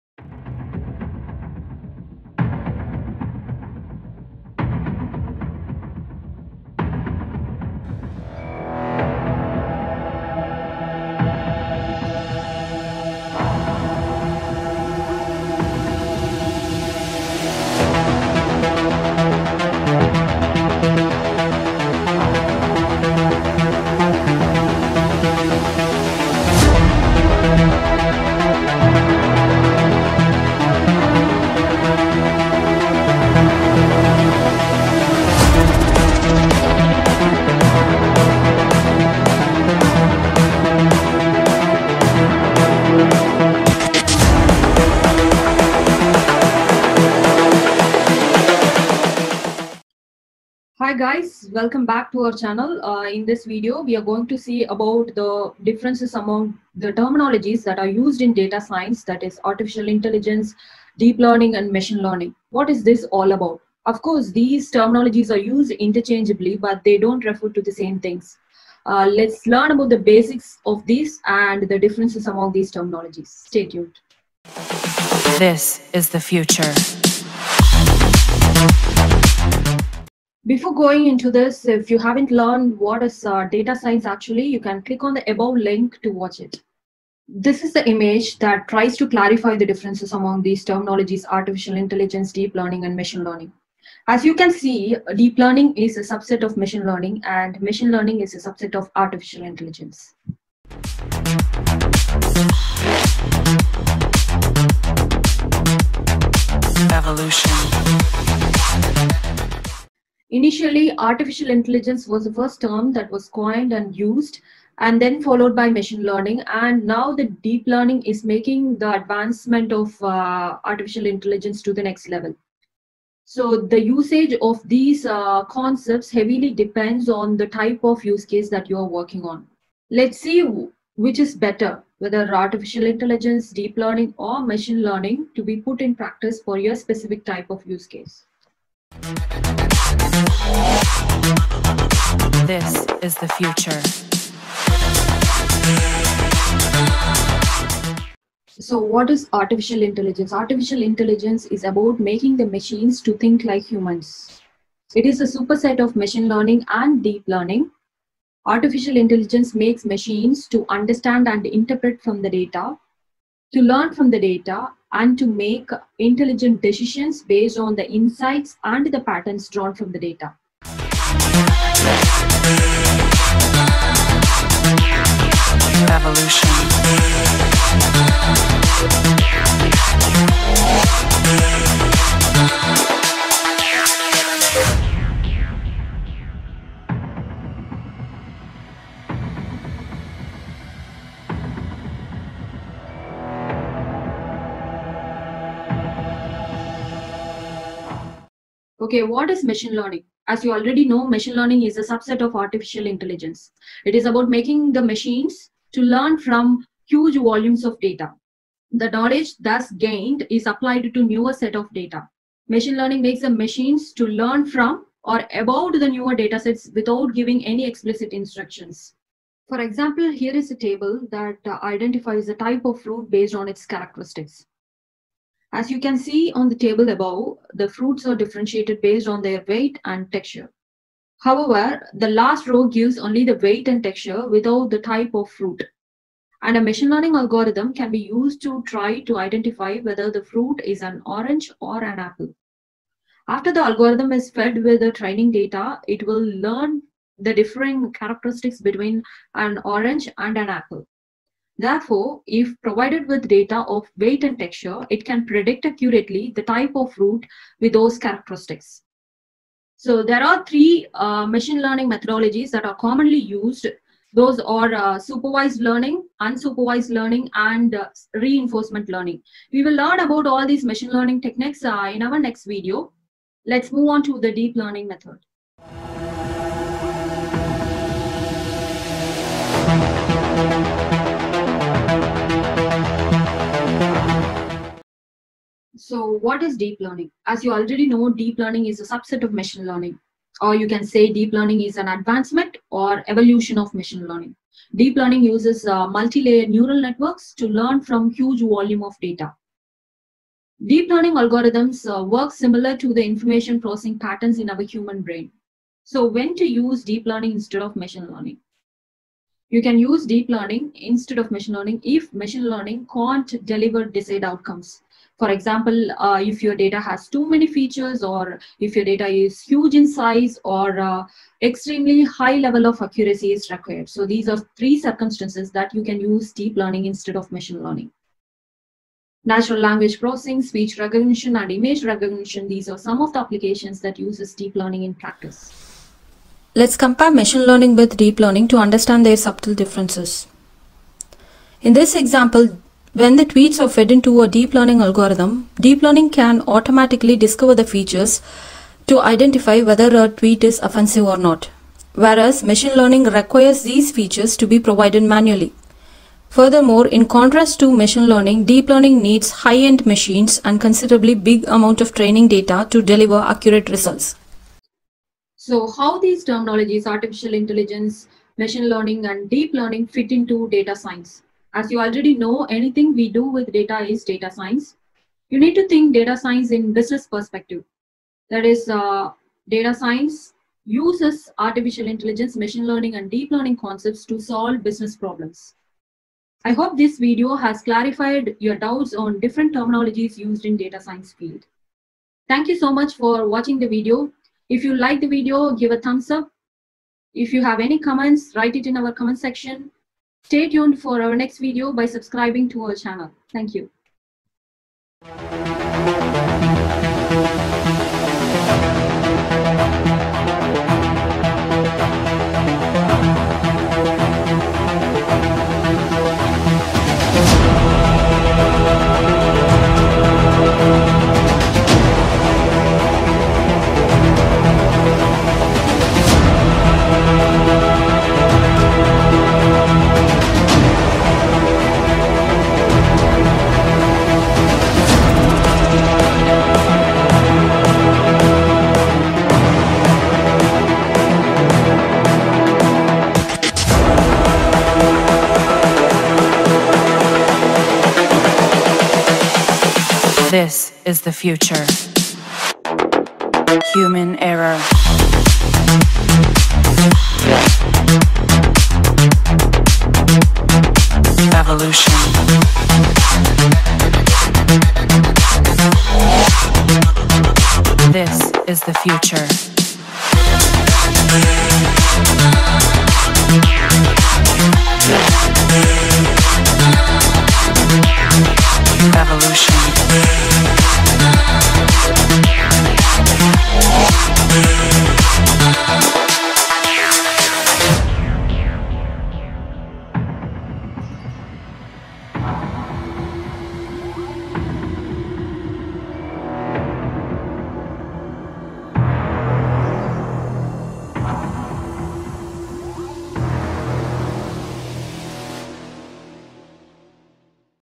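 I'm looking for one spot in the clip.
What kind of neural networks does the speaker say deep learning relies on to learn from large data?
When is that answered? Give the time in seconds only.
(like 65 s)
295 s.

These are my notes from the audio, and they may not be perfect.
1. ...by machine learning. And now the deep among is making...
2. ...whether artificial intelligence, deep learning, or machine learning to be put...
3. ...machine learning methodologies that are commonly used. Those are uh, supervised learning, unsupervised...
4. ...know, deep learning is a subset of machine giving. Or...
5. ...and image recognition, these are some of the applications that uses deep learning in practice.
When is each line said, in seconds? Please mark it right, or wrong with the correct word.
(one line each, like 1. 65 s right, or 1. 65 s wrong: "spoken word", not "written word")
1. 115 s wrong: "learning", not "among"
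2. 131 s right
3. 261 s right
4. 287 s wrong: "learning", not "giving"
5. 331 s right.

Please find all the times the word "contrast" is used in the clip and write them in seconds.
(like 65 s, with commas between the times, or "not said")
357 s.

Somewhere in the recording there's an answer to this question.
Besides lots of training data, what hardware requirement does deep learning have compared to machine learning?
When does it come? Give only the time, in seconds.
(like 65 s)
359 s.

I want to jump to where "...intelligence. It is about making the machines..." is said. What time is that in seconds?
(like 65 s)
202 s.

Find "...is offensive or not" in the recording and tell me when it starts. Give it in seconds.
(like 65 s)
350 s.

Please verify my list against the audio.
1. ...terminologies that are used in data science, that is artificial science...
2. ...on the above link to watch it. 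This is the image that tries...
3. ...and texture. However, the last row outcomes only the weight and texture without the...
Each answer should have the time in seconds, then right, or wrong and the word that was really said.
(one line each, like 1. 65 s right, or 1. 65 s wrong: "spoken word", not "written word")
1. 56 s wrong: "intelligence", not "science"
2. 85 s right
3. 229 s wrong: "gives", not "outcomes".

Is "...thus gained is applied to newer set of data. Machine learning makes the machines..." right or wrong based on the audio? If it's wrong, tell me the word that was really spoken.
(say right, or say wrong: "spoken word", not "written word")
right.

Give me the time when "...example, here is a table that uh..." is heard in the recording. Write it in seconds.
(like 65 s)
219 s.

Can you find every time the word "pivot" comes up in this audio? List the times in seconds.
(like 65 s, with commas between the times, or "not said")
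not said.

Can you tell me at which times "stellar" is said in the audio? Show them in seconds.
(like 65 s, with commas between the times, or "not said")
not said.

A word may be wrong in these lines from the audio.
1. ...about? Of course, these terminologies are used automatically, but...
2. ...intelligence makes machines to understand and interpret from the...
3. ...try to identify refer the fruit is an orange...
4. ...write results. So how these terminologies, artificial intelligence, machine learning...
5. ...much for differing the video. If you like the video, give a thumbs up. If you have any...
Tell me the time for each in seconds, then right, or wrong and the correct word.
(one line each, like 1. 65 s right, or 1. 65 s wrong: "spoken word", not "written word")
1. 63 s wrong: "interchangeably", not "automatically"
2. 158 s right
3. 238 s wrong: "whether", not "refer"
4. 363 s wrong: "accurate", not "write"
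5. 392 s wrong: "watching", not "differing".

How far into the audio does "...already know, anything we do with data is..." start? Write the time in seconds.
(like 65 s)
371 s.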